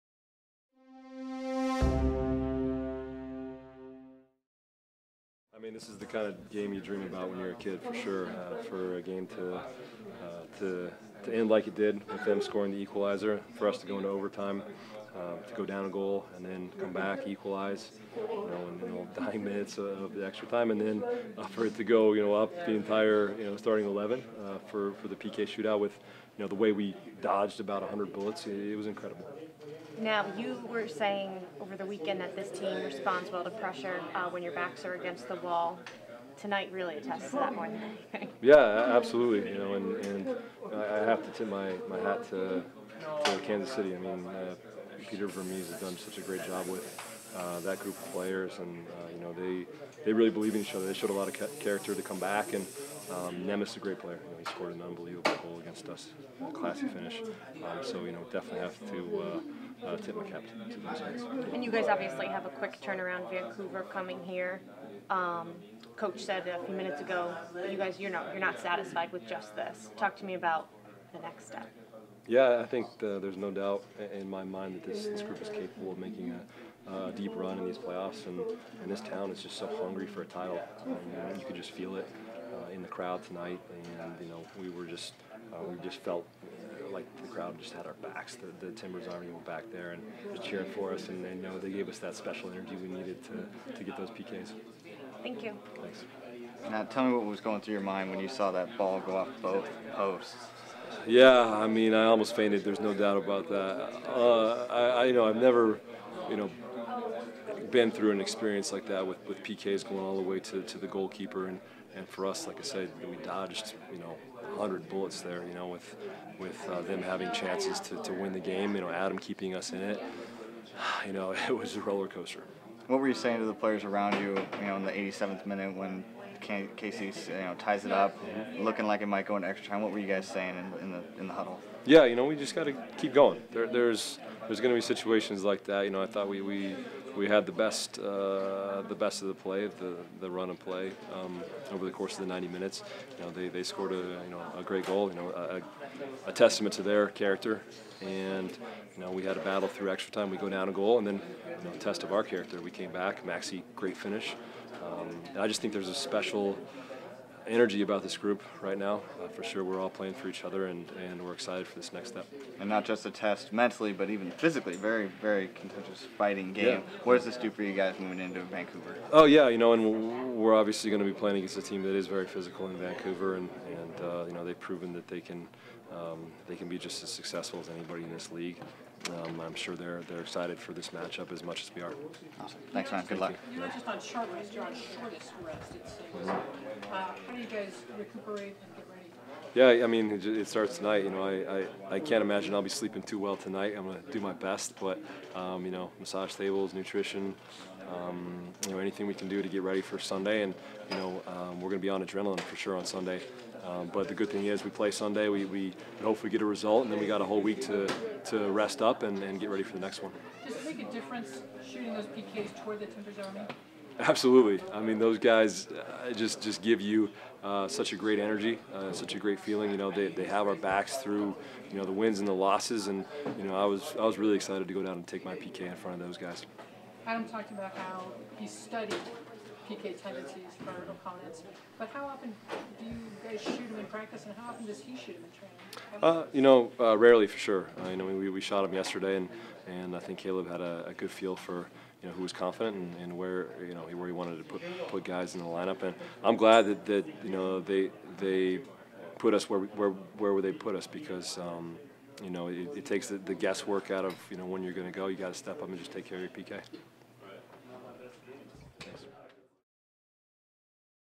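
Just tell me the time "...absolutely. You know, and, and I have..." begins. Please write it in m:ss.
0:38.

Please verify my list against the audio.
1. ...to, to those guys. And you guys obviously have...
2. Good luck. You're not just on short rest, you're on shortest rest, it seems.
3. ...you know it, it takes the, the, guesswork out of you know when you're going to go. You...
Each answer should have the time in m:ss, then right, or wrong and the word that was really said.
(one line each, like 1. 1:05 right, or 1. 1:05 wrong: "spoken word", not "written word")
1. 1:00 right
2. 3:03 right
3. 4:12 right.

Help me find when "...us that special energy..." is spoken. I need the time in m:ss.
1:31.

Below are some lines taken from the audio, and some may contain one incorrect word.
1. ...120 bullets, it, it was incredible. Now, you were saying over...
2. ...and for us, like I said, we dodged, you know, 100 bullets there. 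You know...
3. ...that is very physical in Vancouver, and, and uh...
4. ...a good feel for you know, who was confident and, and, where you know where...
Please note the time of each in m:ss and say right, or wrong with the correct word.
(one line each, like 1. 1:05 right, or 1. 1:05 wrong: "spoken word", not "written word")
1. 0:27 wrong: "100", not "120"
2. 1:51 right
3. 2:51 right
4. 4:00 right.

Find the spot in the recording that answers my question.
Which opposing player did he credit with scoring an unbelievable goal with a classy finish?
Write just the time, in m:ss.
0:53.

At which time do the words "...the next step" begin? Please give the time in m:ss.
1:11.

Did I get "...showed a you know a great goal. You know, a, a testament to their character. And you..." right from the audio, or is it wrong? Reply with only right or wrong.
wrong.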